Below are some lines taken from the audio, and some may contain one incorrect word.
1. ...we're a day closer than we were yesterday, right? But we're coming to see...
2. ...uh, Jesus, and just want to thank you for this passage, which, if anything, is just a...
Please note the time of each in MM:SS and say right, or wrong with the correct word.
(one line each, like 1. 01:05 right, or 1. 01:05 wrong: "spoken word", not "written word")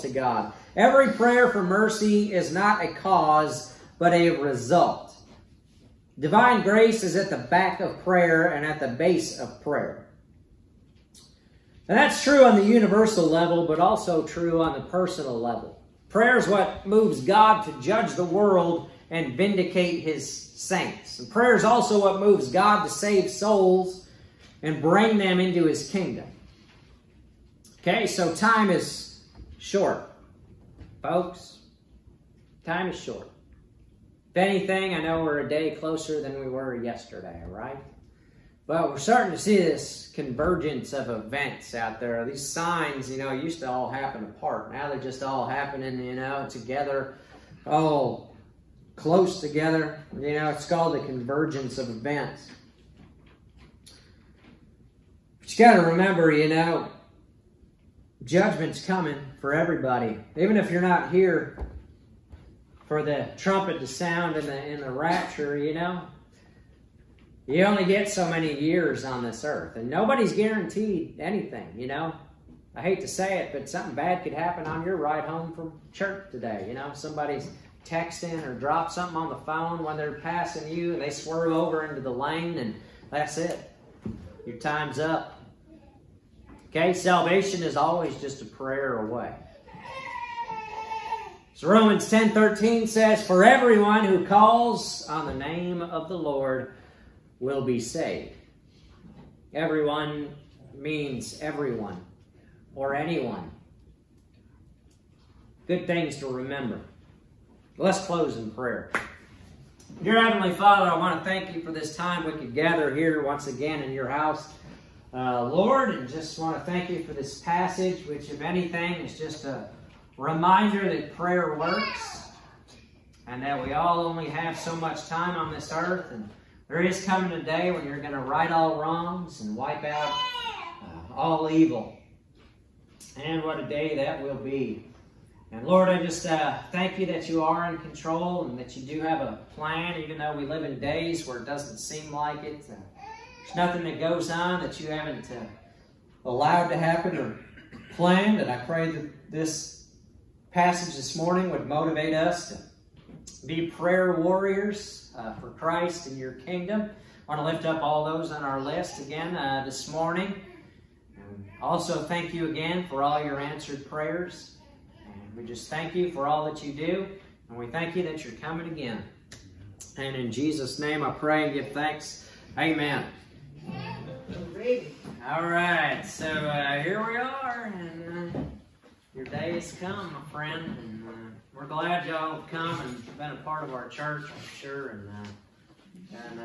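1. 00:35 wrong: "starting", not "coming"
2. 01:55 wrong: "Lord", not "Jesus".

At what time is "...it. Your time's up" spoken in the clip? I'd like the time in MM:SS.
01:23.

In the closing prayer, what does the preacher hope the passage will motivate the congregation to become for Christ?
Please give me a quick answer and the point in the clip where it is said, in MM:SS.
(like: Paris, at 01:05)
prayer warriors, at 02:33.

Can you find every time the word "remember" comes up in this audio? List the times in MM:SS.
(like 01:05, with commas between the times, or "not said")
00:55, 01:46.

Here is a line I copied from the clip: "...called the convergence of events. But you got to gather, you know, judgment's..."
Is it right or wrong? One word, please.
wrong.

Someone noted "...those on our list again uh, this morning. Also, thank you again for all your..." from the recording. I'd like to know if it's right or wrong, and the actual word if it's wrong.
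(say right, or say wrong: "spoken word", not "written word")
right.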